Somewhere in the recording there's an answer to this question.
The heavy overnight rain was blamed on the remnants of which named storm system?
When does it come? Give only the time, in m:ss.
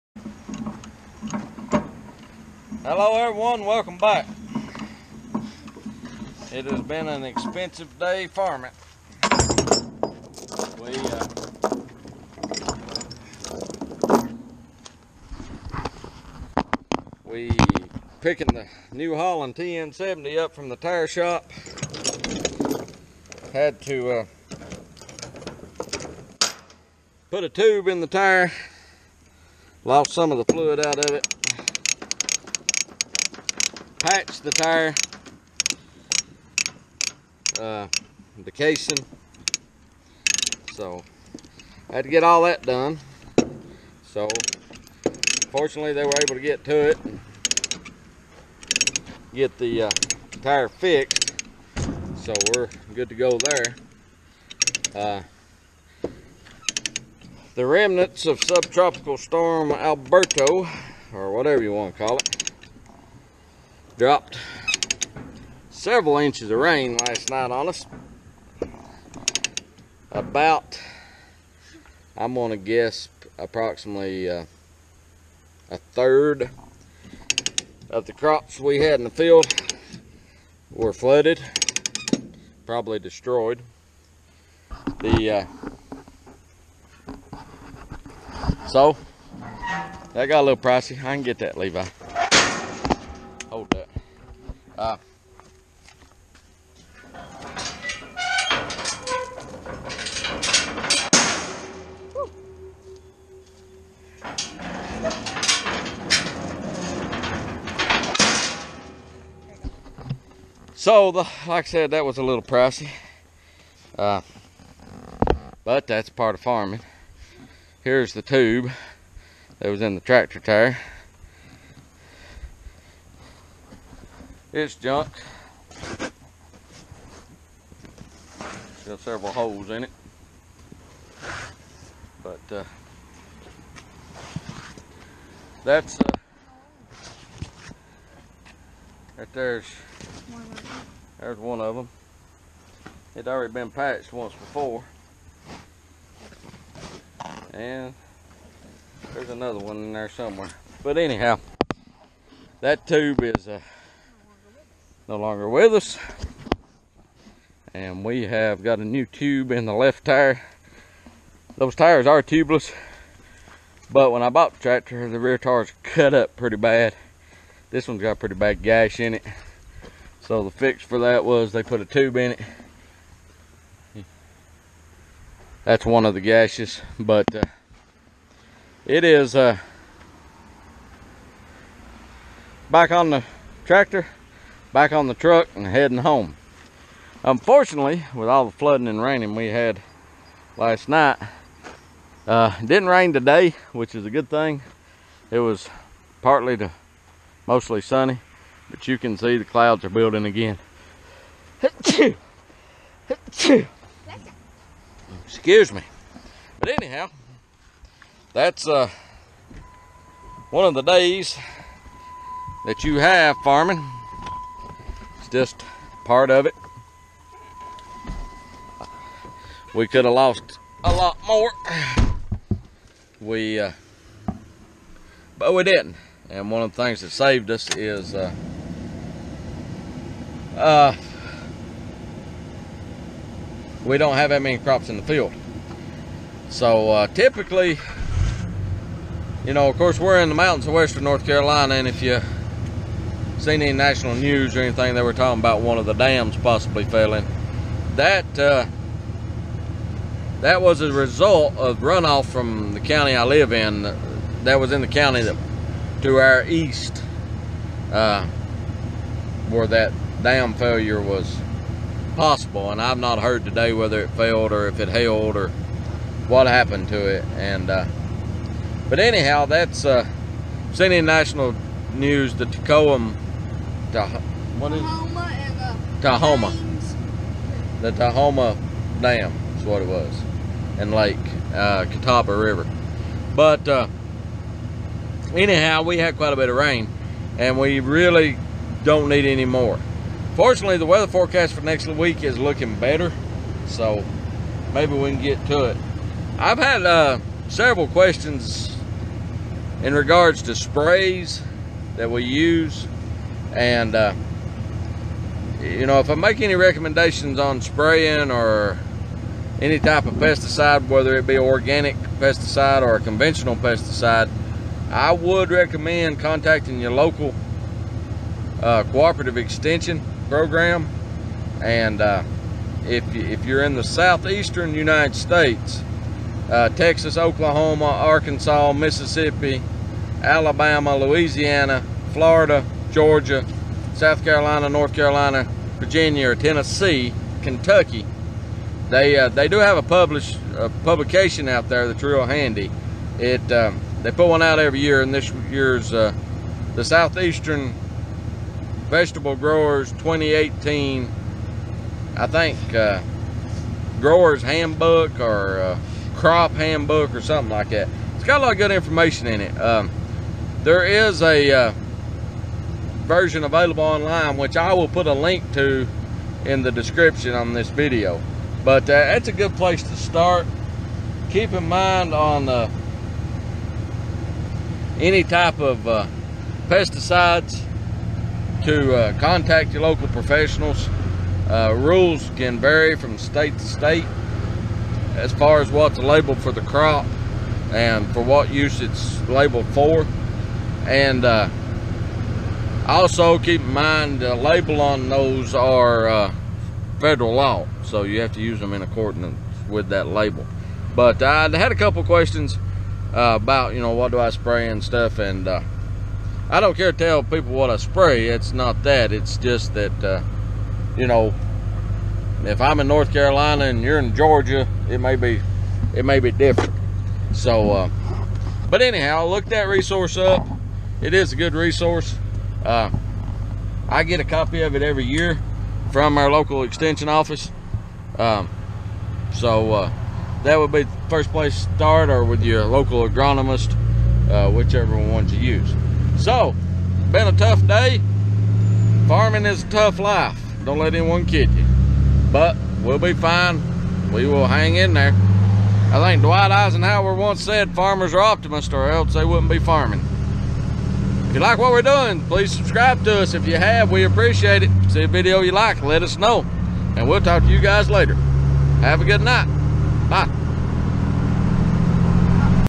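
0:59.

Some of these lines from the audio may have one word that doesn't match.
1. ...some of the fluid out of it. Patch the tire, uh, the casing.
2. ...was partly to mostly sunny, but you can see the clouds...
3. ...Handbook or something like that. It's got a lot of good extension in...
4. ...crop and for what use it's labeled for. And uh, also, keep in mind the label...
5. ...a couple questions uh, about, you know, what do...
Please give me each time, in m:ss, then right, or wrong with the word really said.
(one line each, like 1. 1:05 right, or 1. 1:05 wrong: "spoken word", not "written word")
1. 0:30 right
2. 3:15 right
3. 5:56 wrong: "information", not "extension"
4. 6:26 right
5. 6:41 right.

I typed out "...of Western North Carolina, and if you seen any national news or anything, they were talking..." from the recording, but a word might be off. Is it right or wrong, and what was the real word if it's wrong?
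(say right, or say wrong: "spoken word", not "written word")
right.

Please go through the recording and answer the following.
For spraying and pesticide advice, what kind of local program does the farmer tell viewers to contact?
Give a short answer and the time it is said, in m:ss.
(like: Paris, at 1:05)
cooperative extension program, at 5:18.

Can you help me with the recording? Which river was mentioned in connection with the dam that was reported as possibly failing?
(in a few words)
Catawba River.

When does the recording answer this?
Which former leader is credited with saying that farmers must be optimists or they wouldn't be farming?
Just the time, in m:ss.
7:26.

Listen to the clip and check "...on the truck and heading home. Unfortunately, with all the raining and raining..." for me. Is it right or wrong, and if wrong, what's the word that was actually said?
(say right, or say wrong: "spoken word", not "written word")
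wrong: "flooding", not "raining".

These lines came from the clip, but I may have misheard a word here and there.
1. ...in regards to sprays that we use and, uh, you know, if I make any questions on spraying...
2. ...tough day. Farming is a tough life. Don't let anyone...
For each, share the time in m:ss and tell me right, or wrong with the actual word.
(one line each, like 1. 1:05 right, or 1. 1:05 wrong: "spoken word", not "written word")
1. 4:59 wrong: "recommendations", not "questions"
2. 7:17 right.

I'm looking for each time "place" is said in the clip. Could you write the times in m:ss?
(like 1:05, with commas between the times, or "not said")
6:09, 7:11.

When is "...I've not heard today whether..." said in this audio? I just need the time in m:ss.
4:22.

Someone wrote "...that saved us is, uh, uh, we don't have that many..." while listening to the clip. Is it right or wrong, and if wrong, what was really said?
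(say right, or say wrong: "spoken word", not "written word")
right.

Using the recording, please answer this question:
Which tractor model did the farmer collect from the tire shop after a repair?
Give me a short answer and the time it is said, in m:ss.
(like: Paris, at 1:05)
New Holland TN70, at 0:18.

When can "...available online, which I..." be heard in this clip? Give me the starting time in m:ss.
6:03.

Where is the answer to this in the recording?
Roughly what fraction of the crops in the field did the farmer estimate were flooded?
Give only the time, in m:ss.
1:15.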